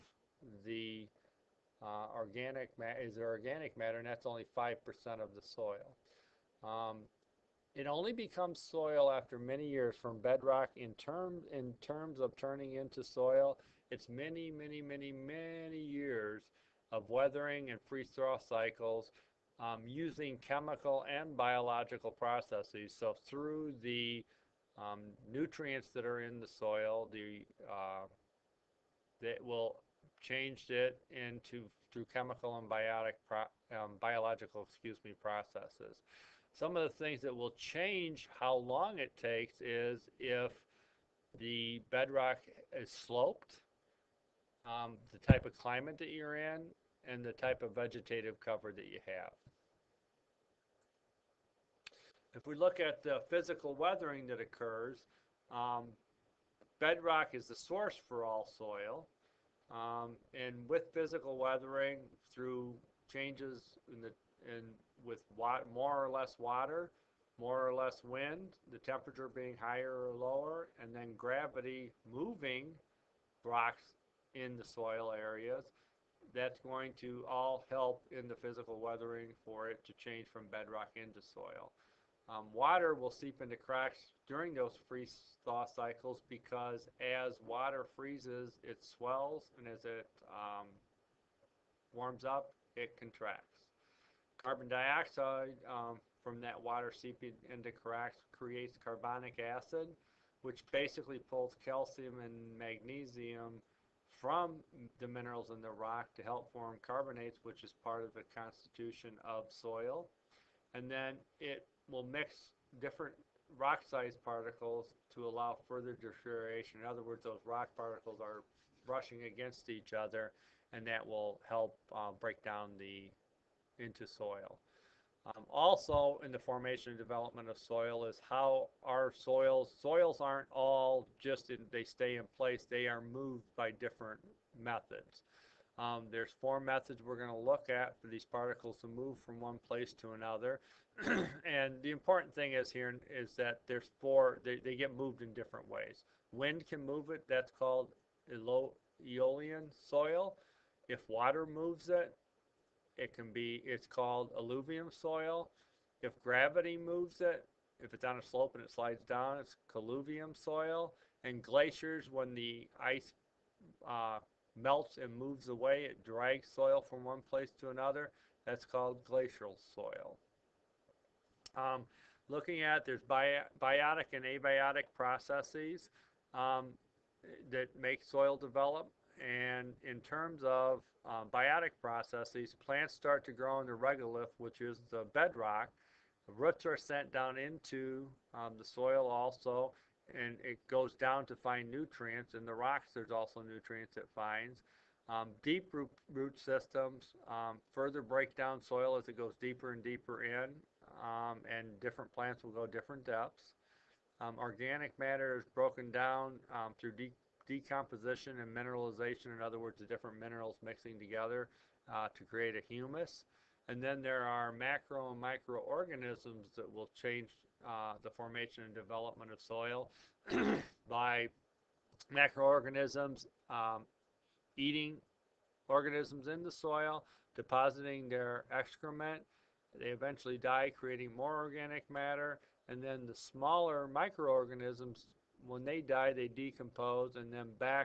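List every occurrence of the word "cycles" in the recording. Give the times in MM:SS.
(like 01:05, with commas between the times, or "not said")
00:18, 01:25.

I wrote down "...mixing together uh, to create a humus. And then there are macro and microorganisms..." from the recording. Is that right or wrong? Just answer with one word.
right.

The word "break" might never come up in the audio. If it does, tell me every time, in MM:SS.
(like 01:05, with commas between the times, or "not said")
02:02, 03:18.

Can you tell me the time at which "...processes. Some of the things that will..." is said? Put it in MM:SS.
00:35.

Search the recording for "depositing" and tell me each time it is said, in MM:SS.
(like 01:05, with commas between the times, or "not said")
03:47.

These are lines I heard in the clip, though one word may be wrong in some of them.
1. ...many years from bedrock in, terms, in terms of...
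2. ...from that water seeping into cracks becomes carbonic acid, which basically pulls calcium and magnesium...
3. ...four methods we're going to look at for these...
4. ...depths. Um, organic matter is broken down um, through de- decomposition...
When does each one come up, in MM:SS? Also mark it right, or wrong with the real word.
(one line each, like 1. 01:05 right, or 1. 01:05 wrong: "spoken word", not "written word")
1. 00:09 right
2. 01:36 wrong: "creates", not "becomes"
3. 02:16 right
4. 03:23 right.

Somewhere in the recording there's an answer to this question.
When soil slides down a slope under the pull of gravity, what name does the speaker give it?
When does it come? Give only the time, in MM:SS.
02:39.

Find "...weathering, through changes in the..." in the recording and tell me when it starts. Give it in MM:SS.
01:01.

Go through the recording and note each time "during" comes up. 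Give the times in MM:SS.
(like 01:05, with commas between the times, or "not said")
01:24.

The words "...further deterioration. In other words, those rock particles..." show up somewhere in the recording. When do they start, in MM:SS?
01:55.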